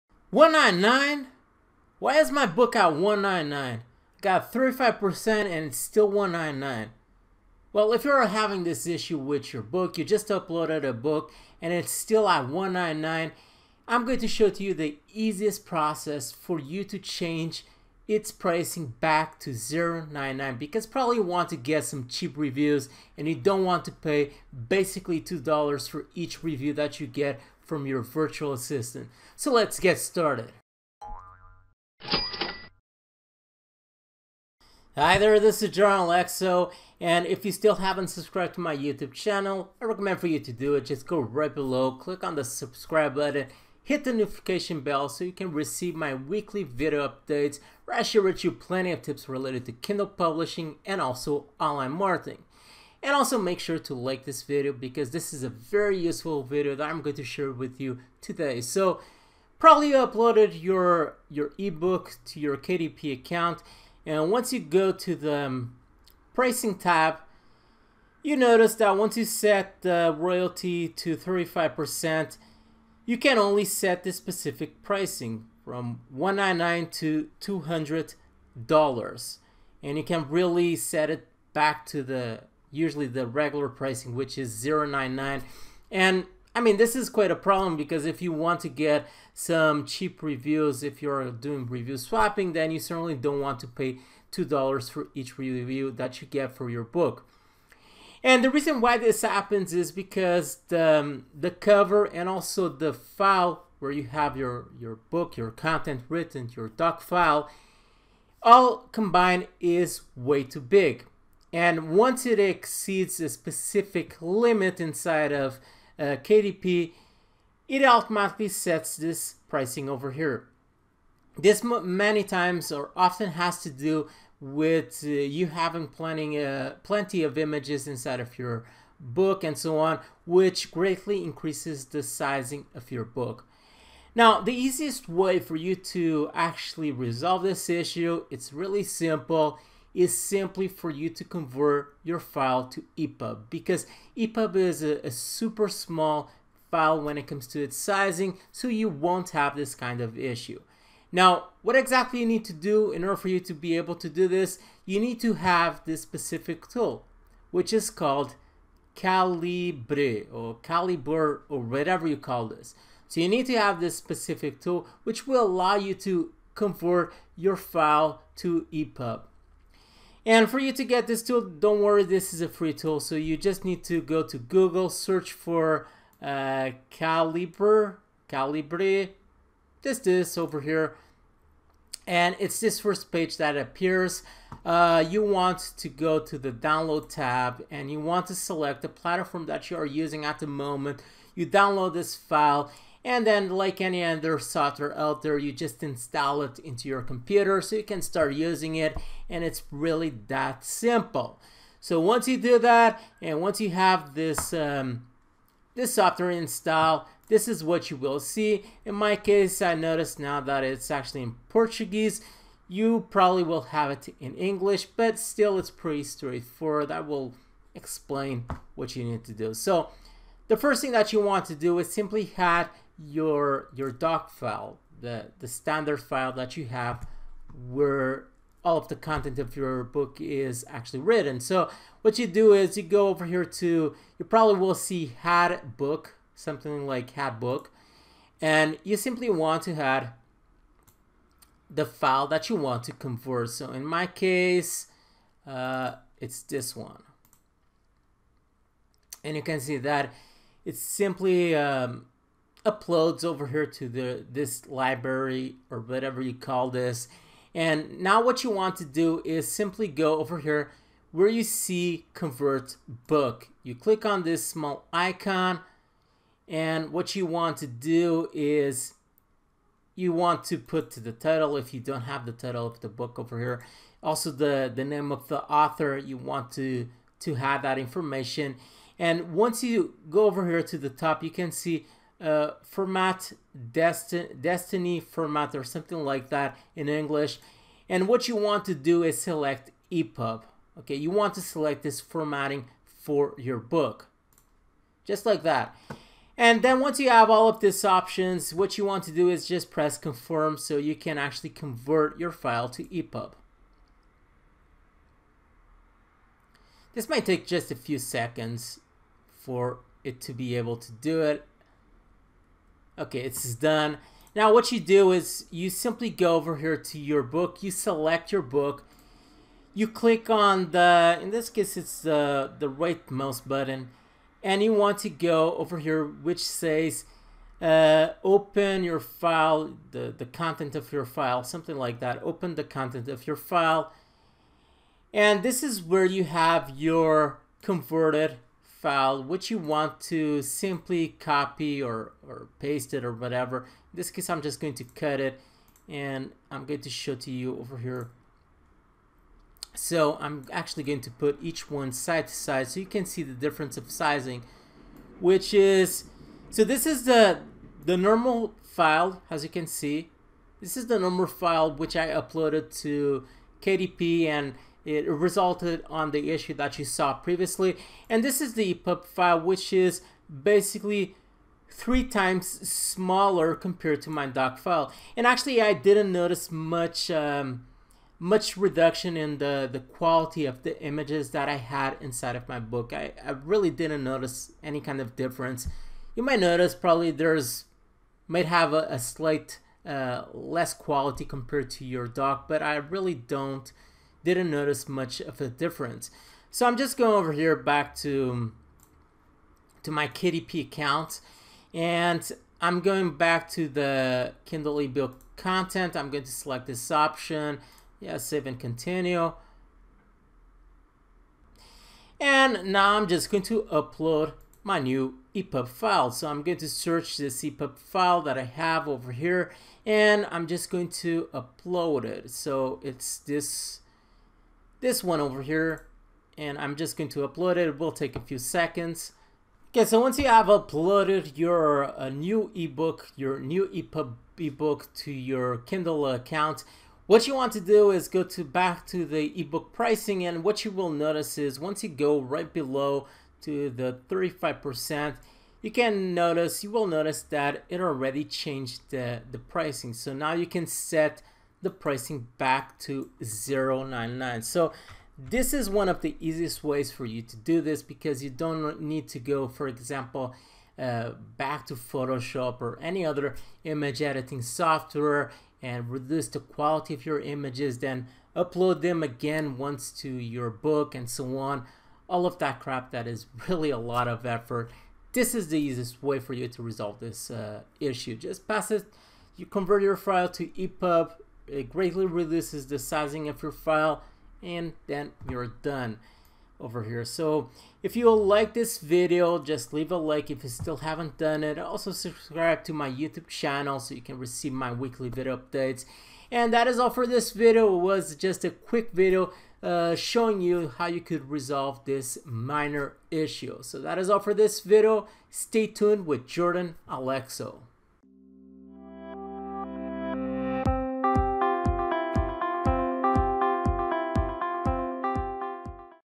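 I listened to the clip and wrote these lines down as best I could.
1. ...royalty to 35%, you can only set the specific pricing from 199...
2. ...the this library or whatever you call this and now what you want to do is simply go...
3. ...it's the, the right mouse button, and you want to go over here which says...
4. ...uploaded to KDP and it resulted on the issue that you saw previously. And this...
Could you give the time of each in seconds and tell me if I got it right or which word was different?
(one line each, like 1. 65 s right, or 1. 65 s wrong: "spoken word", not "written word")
1. 70 s right
2. 253 s right
3. 321 s right
4. 362 s right.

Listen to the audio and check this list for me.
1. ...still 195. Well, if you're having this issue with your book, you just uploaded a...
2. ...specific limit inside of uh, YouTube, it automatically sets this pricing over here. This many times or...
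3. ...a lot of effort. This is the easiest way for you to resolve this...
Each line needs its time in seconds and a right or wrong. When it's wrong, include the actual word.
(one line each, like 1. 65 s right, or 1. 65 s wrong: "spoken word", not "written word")
1. 5 s wrong: "199", not "195"
2. 113 s wrong: "KDP", not "YouTube"
3. 473 s right.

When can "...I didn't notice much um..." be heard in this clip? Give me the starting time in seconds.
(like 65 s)
375 s.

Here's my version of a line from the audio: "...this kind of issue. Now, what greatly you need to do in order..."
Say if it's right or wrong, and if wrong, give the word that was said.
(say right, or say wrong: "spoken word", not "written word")
wrong: "exactly", not "greatly".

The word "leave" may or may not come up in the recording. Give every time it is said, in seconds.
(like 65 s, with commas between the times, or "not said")
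489 s.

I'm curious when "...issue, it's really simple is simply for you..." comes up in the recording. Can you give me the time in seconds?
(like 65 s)
137 s.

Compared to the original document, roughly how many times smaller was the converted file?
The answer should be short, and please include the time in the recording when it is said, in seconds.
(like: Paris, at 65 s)
3 times, at 371 s.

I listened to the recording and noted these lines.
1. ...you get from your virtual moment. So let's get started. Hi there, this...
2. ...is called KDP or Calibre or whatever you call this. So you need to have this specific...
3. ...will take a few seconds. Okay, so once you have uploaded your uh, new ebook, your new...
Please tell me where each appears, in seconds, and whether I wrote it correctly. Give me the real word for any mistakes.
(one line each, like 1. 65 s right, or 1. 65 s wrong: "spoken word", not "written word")
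1. 27 s wrong: "assistant", not "moment"
2. 157 s wrong: "Calibre", not "KDP"
3. 427 s right.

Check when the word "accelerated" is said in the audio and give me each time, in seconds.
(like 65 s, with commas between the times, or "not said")
not said.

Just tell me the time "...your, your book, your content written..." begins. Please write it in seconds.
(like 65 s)
104 s.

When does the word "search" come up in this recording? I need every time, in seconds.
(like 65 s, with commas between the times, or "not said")
174 s, 416 s.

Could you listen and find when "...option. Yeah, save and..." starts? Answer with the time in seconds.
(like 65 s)
406 s.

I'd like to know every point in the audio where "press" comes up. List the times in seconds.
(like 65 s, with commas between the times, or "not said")
299 s.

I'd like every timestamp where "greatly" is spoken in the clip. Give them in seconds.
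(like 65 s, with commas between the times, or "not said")
130 s, 481 s.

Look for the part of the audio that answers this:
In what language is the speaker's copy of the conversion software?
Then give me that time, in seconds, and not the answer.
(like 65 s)
211 s.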